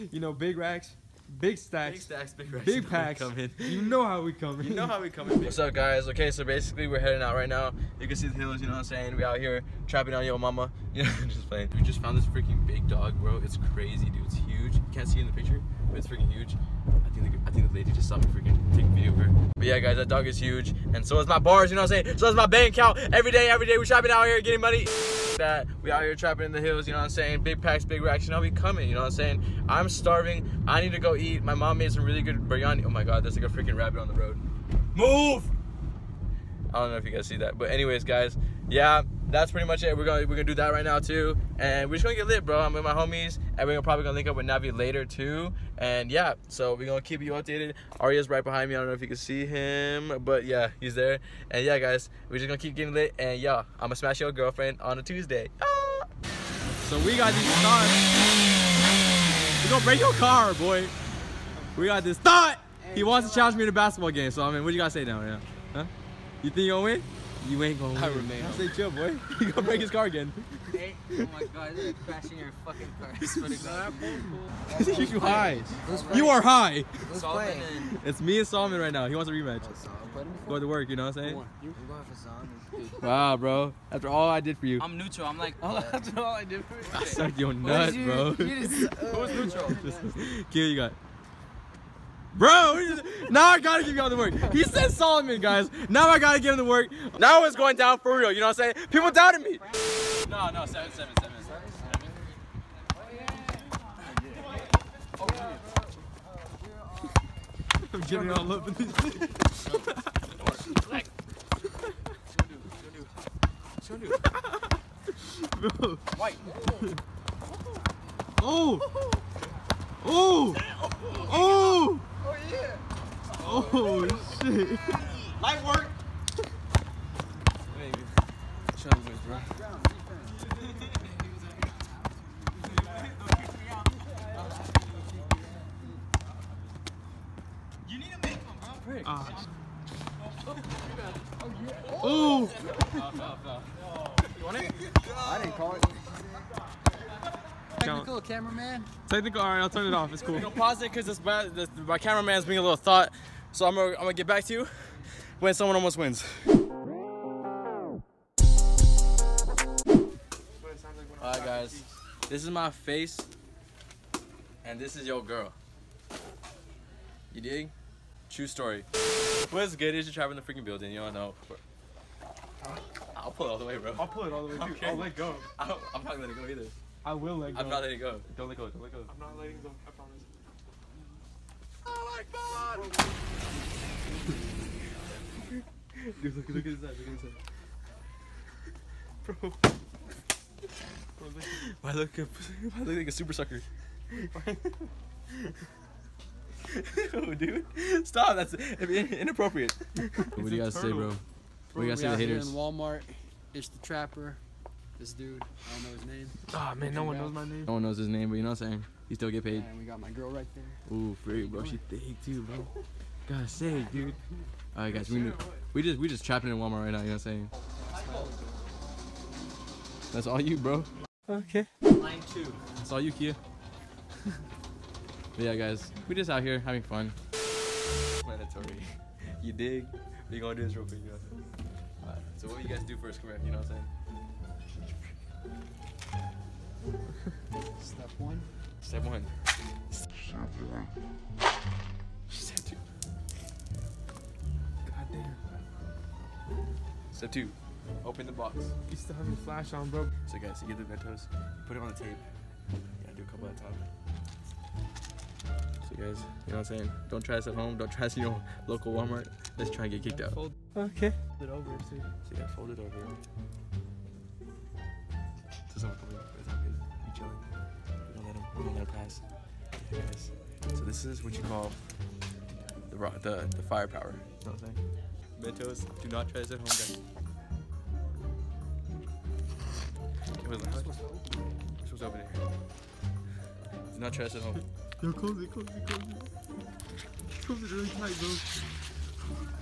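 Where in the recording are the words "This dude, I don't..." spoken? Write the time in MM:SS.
03:24.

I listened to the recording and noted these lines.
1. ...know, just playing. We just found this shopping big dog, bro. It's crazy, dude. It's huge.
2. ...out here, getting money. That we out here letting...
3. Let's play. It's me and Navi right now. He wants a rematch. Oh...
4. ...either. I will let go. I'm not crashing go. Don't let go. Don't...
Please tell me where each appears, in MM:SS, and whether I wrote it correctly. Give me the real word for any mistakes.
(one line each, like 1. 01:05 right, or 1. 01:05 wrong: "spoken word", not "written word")
1. 00:11 wrong: "freaking", not "shopping"
2. 00:24 wrong: "trapping", not "letting"
3. 01:17 wrong: "Solomon", not "Navi"
4. 02:56 wrong: "letting", not "crashing".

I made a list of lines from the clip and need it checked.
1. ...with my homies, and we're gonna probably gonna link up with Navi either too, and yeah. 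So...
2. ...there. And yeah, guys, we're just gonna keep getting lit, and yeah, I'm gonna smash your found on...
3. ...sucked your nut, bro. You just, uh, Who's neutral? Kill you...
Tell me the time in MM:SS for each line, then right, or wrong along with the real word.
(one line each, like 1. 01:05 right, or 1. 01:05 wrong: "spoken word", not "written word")
1. 00:42 wrong: "later", not "either"
2. 00:50 wrong: "girlfriend", not "found"
3. 01:27 right.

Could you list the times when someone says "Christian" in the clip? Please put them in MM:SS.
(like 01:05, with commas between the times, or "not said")
not said.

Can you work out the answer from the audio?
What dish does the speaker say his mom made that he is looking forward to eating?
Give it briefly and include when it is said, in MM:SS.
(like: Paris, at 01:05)
Biryani, at 00:32.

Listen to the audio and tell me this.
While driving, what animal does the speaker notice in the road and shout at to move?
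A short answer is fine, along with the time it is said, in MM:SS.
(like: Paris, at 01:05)
Rabbit, at 00:33.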